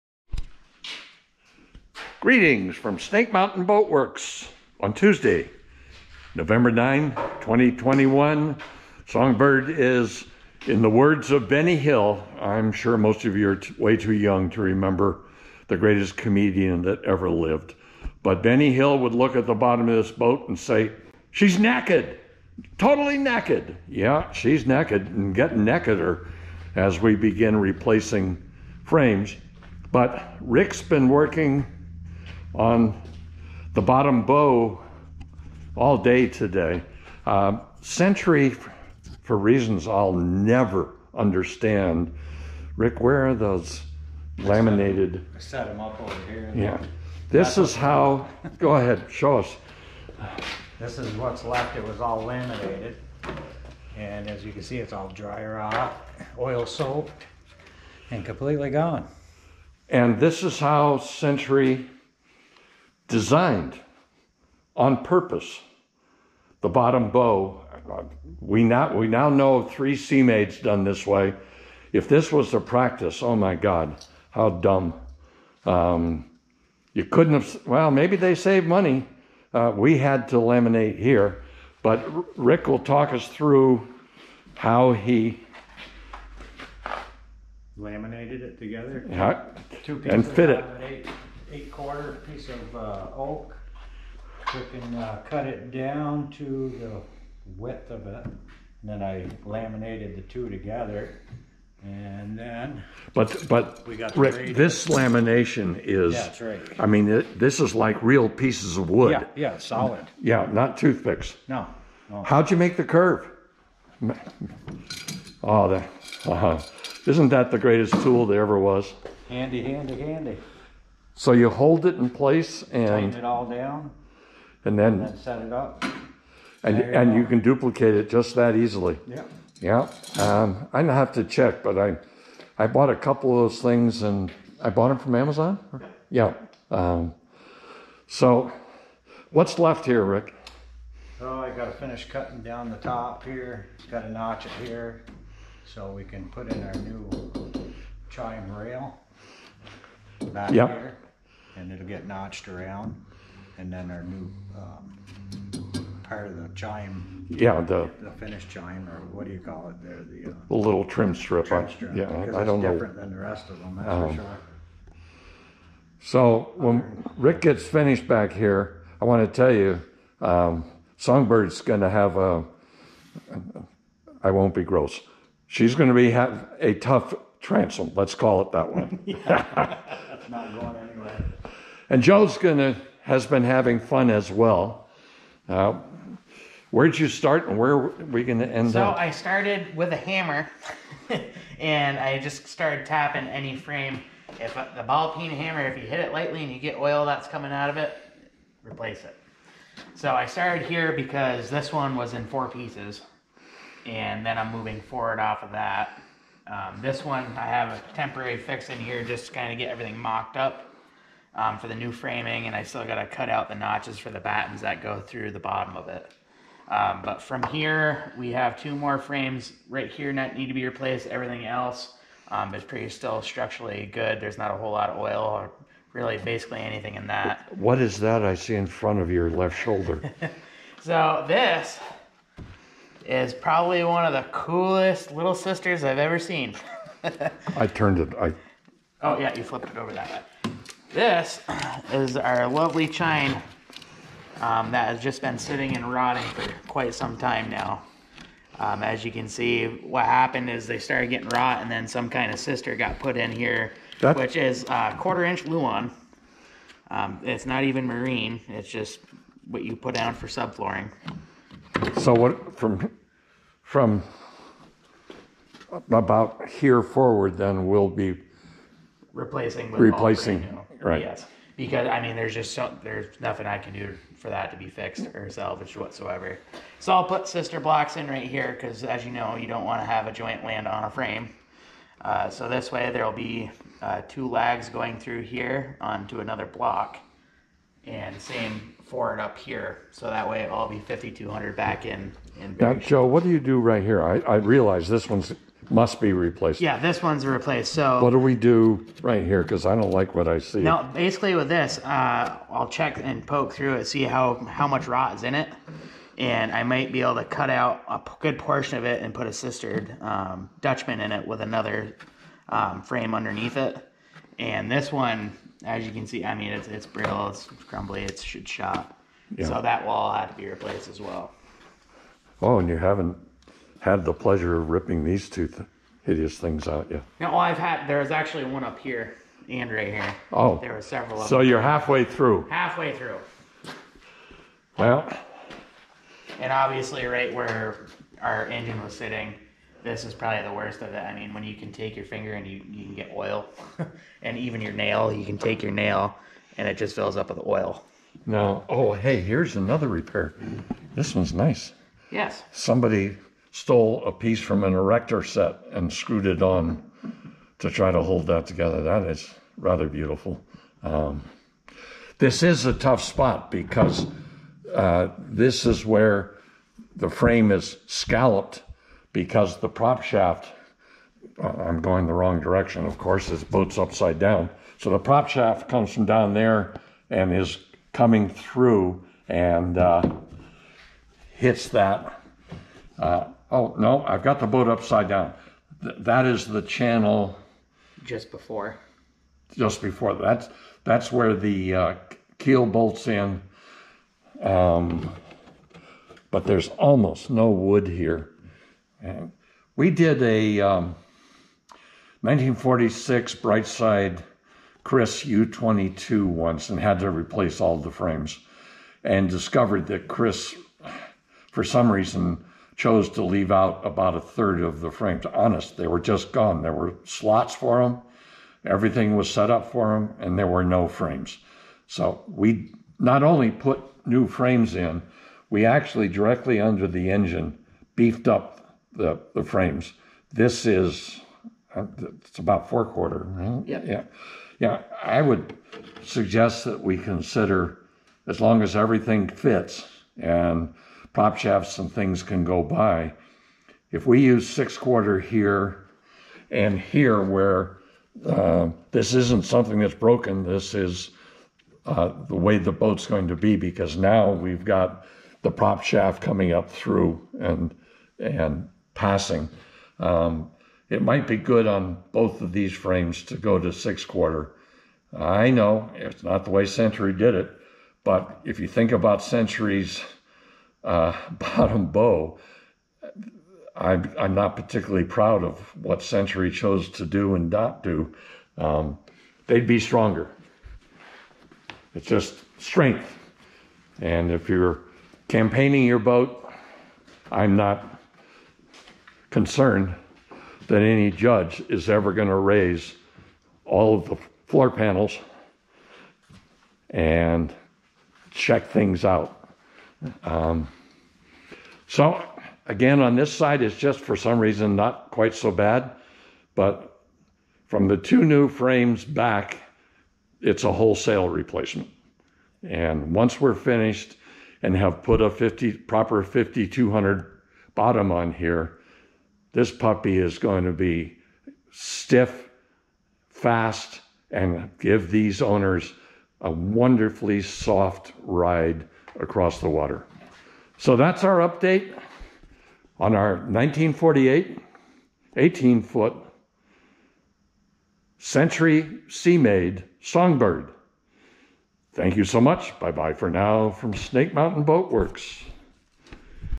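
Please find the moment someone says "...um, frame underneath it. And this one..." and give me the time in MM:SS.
05:12.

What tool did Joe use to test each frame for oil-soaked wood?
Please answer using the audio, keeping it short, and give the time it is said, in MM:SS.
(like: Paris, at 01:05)
ball peen hammer, at 03:14.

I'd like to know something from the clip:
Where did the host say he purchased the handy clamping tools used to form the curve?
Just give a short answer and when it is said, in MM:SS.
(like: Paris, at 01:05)
Amazon, at 02:15.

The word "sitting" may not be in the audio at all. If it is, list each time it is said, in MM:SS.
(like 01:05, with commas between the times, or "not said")
04:05, 05:38.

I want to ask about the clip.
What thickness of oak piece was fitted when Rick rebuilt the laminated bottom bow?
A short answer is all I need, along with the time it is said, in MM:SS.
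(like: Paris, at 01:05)
eight quarter, at 01:31.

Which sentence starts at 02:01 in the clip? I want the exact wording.
So you hold it in place and tighten it all down, and then, and then set it up.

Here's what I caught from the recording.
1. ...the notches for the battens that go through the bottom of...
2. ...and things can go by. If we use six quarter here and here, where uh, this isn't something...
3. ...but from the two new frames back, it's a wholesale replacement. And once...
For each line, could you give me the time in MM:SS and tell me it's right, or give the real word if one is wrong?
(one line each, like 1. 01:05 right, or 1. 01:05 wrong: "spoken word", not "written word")
1. 03:33 right
2. 07:21 right
3. 08:26 right.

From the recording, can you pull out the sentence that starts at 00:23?
Yeah, she's naked and getting nakeder as we begin replacing frames.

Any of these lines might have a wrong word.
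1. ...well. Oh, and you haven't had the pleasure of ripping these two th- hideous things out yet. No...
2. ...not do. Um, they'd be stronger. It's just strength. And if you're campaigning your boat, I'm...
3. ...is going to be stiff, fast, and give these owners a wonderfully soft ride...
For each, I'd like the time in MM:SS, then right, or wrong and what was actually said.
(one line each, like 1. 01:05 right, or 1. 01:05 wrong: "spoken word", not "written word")
1. 05:20 right
2. 07:57 right
3. 08:40 right.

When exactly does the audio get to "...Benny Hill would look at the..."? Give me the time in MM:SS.
00:18.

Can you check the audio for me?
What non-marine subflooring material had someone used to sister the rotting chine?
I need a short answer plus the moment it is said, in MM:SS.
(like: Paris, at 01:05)
quarter-inch Luan, at 04:14.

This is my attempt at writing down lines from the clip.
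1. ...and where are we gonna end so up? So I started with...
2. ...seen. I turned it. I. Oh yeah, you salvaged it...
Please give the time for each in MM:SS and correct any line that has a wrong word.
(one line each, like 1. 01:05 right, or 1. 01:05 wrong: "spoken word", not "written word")
1. 03:07 right
2. 03:56 wrong: "flipped", not "salvaged".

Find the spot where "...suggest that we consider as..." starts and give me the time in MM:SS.
07:16.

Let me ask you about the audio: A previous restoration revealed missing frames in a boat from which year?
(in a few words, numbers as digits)
1946.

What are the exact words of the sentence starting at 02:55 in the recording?
She's going to be have a tough transom.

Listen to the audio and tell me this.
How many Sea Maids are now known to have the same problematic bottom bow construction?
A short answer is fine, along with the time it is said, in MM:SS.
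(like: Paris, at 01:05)
3, at 01:09.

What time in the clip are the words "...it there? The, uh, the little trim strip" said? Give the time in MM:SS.
02:39.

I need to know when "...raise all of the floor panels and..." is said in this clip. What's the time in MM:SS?
08:12.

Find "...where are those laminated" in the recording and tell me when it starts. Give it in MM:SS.
00:42.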